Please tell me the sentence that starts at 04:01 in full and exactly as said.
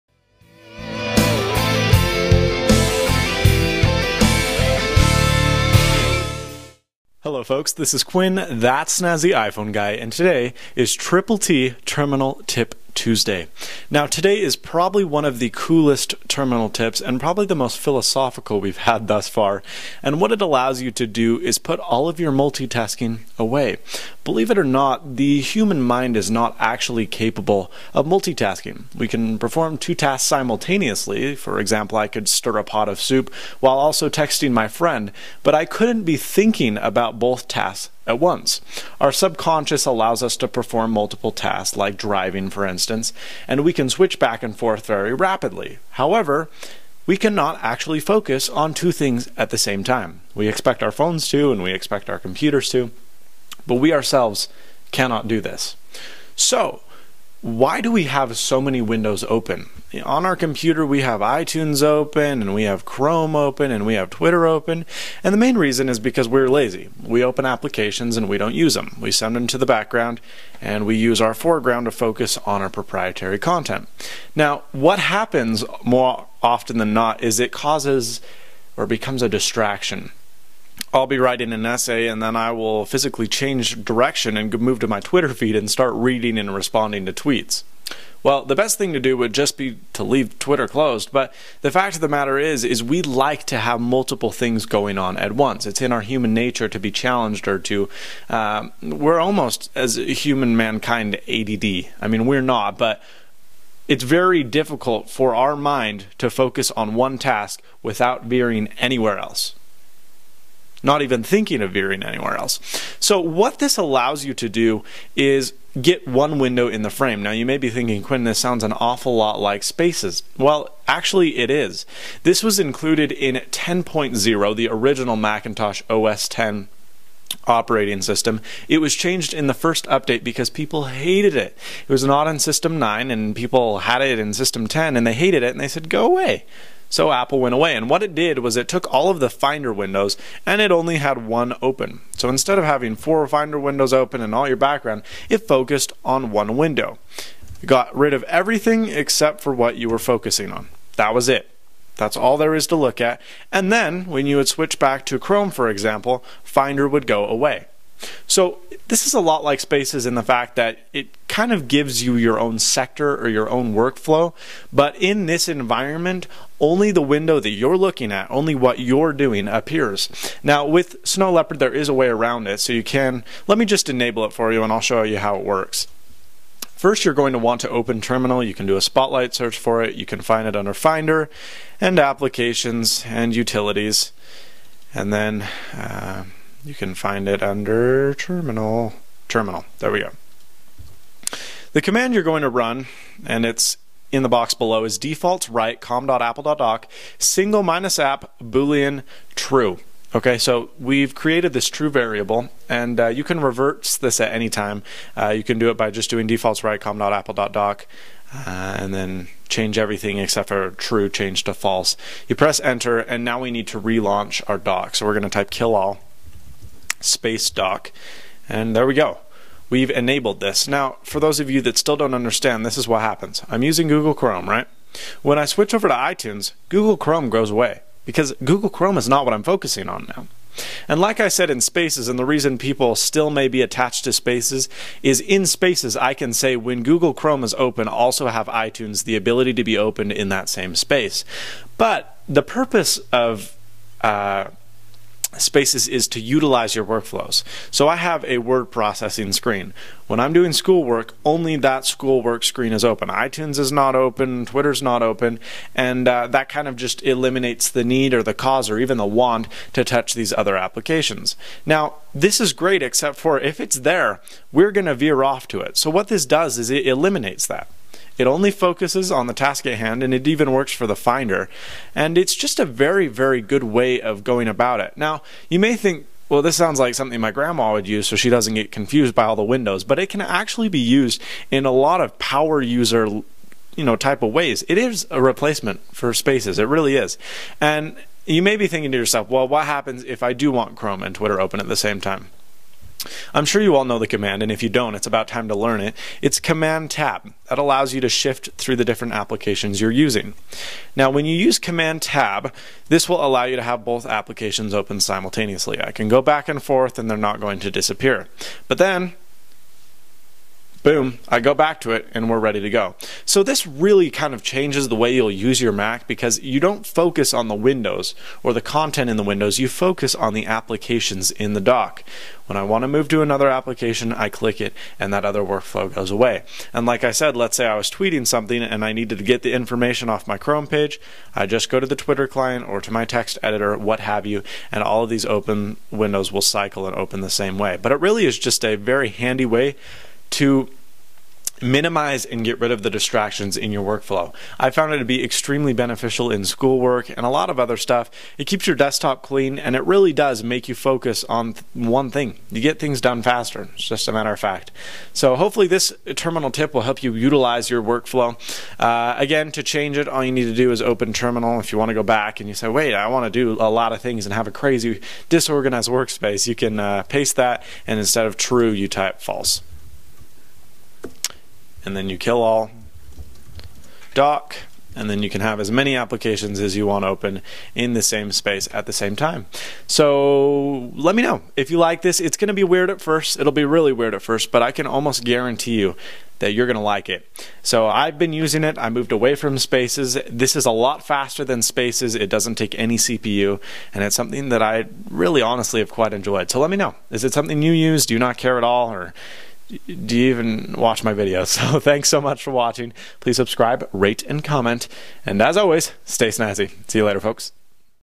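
But the purpose of uh, spaces is to utilize your workflows.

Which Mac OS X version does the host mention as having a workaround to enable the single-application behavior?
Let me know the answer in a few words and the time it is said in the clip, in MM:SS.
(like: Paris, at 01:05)
Snow Leopard, at 02:51.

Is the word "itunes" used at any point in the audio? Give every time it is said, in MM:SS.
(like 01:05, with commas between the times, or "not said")
01:01, 03:45, 03:58, 04:13.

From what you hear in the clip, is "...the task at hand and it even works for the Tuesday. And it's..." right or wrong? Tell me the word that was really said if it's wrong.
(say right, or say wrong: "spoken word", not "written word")
wrong: "Finder", not "Tuesday".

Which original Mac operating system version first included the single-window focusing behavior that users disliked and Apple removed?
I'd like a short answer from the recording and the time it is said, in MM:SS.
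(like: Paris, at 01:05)
10.0, at 02:03.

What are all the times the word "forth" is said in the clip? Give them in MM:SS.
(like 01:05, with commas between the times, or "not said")
00:44, 05:06.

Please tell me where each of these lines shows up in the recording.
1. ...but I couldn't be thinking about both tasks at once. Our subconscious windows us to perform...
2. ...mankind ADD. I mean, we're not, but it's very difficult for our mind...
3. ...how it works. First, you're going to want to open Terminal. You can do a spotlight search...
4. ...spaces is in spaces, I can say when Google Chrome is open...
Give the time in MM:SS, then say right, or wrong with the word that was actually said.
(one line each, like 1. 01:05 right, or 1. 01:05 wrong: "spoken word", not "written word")
1. 00:35 wrong: "allows", not "windows"
2. 01:40 right
3. 02:55 right
4. 03:54 right.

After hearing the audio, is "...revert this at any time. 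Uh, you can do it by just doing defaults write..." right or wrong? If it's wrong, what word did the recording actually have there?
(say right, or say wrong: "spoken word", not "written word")
right.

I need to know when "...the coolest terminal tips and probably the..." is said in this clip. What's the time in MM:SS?
00:15.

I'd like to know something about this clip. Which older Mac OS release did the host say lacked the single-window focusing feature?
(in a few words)
System 9.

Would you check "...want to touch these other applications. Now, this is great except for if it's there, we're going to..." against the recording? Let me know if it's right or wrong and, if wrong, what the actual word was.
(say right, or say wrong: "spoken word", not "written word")
right.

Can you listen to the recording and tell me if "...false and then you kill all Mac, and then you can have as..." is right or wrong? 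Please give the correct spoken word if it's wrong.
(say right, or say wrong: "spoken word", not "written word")
wrong: "Dock", not "Mac".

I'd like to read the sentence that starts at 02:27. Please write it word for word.
It got rid of everything except for what you were focusing on.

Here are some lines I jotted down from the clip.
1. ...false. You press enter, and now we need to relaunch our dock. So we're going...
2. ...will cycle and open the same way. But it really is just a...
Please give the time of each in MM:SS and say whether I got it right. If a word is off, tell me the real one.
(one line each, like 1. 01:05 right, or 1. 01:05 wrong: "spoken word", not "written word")
1. 03:31 right
2. 05:36 right.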